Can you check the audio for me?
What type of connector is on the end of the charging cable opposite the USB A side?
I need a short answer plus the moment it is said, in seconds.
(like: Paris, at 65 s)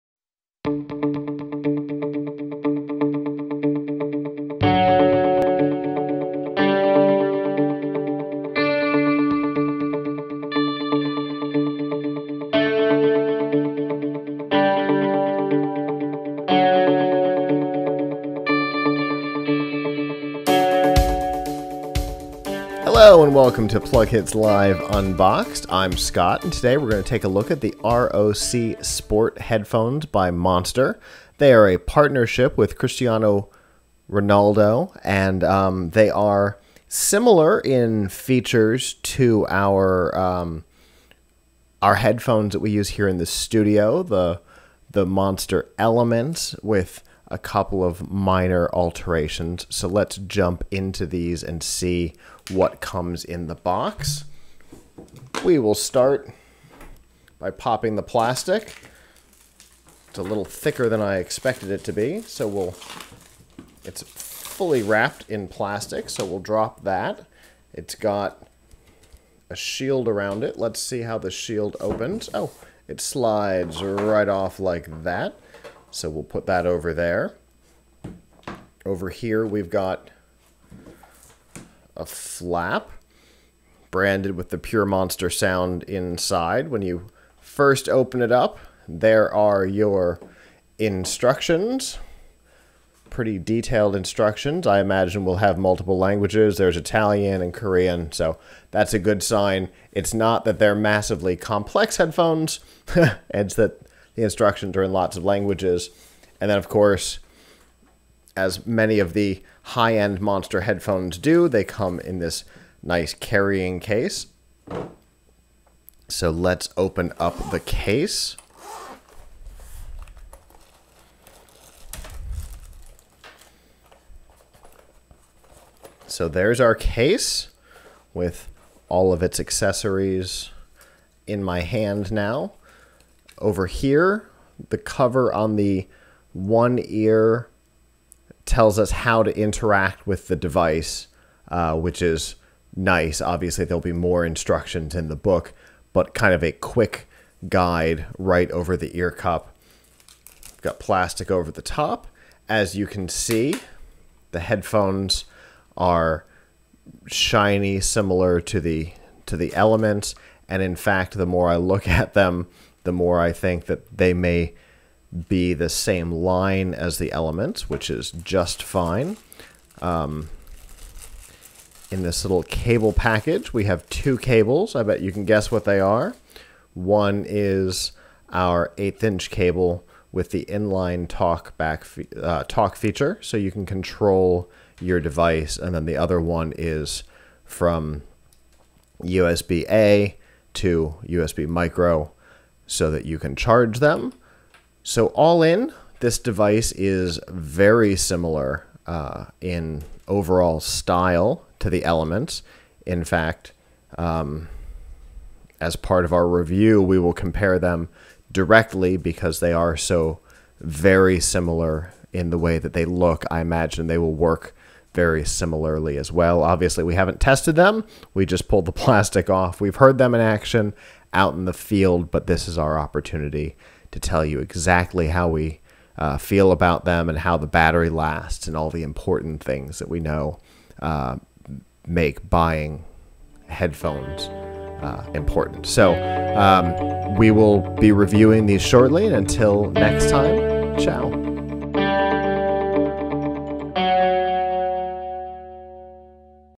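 USB micro, at 191 s.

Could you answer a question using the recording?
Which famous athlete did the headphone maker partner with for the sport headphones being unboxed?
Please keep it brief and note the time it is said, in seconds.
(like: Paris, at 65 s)
Cristiano Ronaldo, at 32 s.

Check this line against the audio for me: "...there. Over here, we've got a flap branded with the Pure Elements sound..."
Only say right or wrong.
wrong.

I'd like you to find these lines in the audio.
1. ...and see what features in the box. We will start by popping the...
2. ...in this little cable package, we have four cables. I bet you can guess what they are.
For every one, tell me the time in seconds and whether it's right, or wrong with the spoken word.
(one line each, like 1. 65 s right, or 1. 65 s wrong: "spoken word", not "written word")
1. 51 s wrong: "comes", not "features"
2. 171 s wrong: "two", not "four".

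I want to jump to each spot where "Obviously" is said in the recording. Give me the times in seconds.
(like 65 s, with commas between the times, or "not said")
143 s, 216 s.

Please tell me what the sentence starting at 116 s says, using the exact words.
So let's open up the case.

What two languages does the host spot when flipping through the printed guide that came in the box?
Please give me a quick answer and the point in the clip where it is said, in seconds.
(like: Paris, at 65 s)
Italian and Korean, at 96 s.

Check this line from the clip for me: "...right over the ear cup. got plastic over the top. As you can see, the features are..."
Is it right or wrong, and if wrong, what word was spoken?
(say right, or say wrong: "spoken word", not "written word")
wrong: "headphones", not "features".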